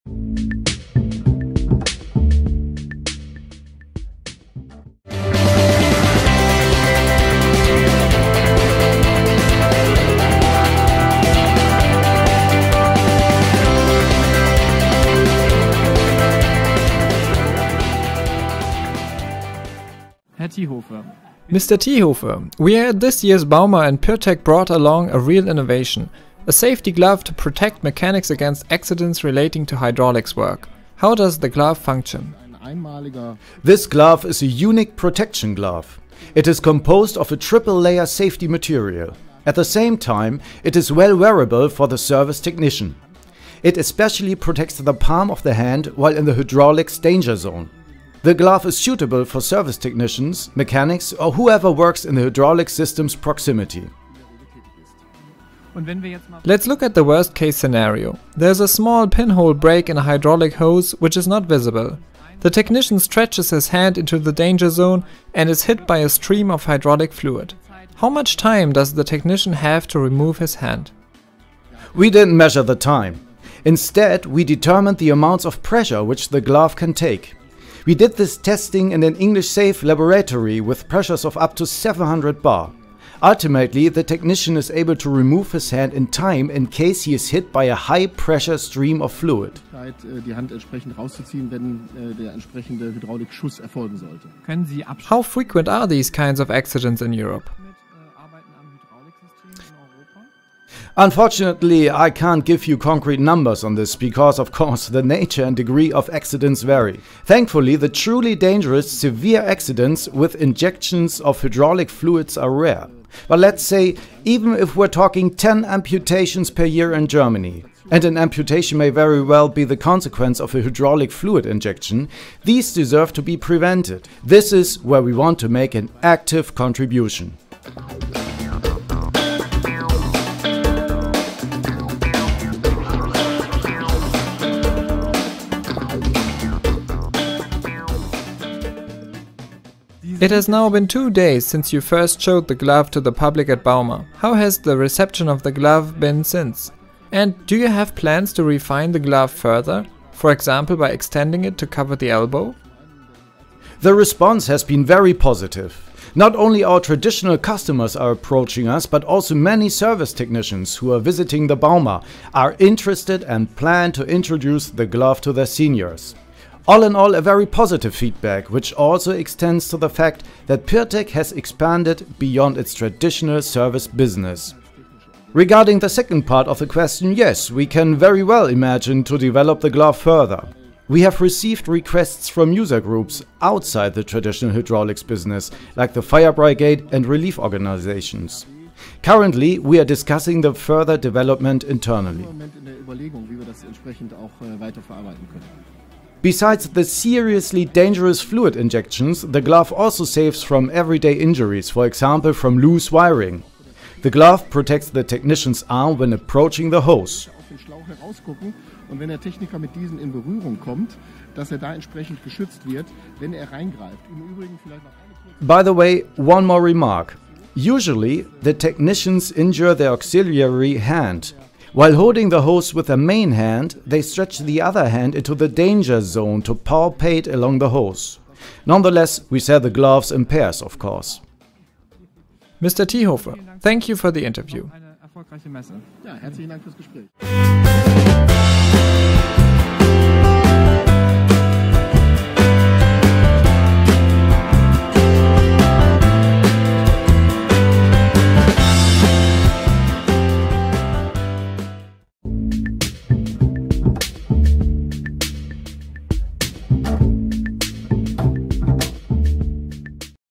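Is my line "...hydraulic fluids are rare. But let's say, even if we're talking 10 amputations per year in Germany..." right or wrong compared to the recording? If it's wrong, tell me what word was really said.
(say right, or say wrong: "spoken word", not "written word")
right.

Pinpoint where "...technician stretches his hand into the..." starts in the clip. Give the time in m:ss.
1:02.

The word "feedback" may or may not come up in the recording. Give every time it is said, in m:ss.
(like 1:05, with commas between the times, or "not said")
2:47.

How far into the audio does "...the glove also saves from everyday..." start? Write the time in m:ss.
3:19.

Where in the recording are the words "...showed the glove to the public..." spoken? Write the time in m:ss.
2:22.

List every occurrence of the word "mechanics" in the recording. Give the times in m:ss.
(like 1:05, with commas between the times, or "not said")
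0:27, 0:50.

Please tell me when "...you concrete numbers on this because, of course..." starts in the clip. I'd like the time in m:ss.
1:42.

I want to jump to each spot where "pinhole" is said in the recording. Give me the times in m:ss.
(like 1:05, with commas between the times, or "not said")
0:59.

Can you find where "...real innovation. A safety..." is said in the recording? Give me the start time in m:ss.
0:25.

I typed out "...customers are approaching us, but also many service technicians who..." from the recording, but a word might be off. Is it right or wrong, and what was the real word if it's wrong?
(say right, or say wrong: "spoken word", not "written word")
right.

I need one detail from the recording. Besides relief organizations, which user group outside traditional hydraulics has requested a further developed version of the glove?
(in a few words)
fire brigade.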